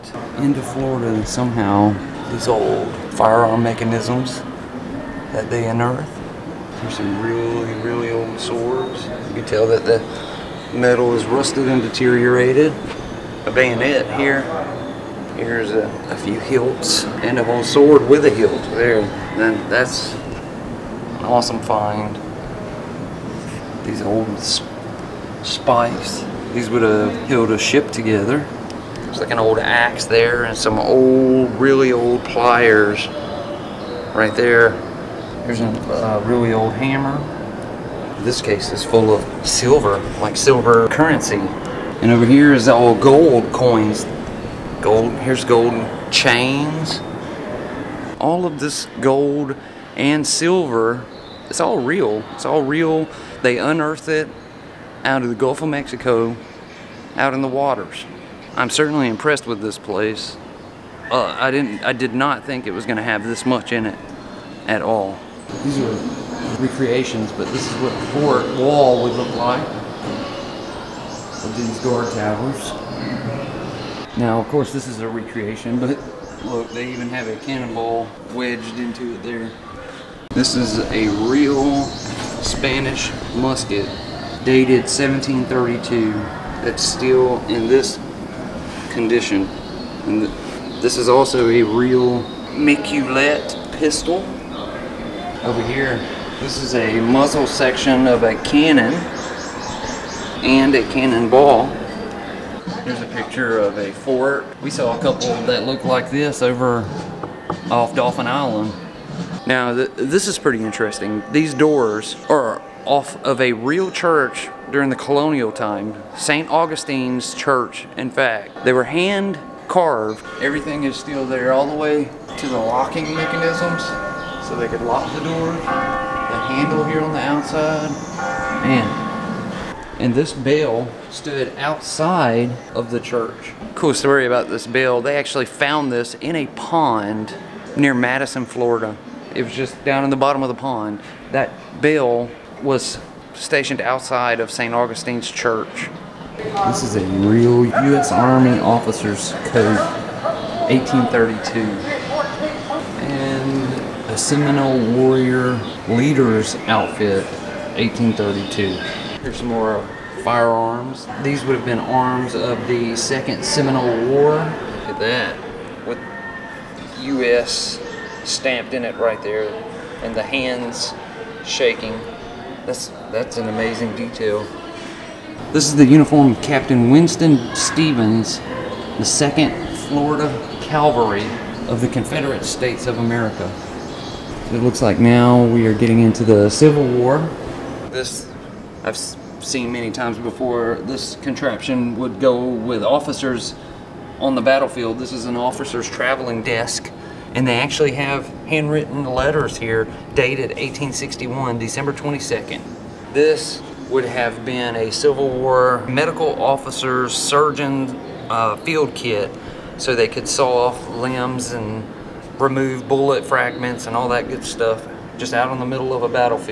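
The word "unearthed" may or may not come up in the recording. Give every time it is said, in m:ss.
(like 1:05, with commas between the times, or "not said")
0:05, 0:53.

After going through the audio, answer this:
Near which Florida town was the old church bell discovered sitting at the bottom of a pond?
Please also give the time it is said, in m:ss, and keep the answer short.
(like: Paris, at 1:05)
Madison, Florida, at 2:17.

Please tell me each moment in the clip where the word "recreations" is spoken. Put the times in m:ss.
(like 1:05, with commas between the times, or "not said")
1:06, 1:15.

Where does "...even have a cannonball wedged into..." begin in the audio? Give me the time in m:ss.
1:16.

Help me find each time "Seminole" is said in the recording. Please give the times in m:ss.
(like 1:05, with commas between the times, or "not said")
2:34, 2:43.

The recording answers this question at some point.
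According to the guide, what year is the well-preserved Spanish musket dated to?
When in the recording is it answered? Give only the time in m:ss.
1:24.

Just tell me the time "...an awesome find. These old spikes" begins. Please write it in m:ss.
0:21.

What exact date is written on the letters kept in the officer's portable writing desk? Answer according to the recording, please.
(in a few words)
December 22, 1861.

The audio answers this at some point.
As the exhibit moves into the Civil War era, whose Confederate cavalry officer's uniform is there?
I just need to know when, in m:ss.
2:56.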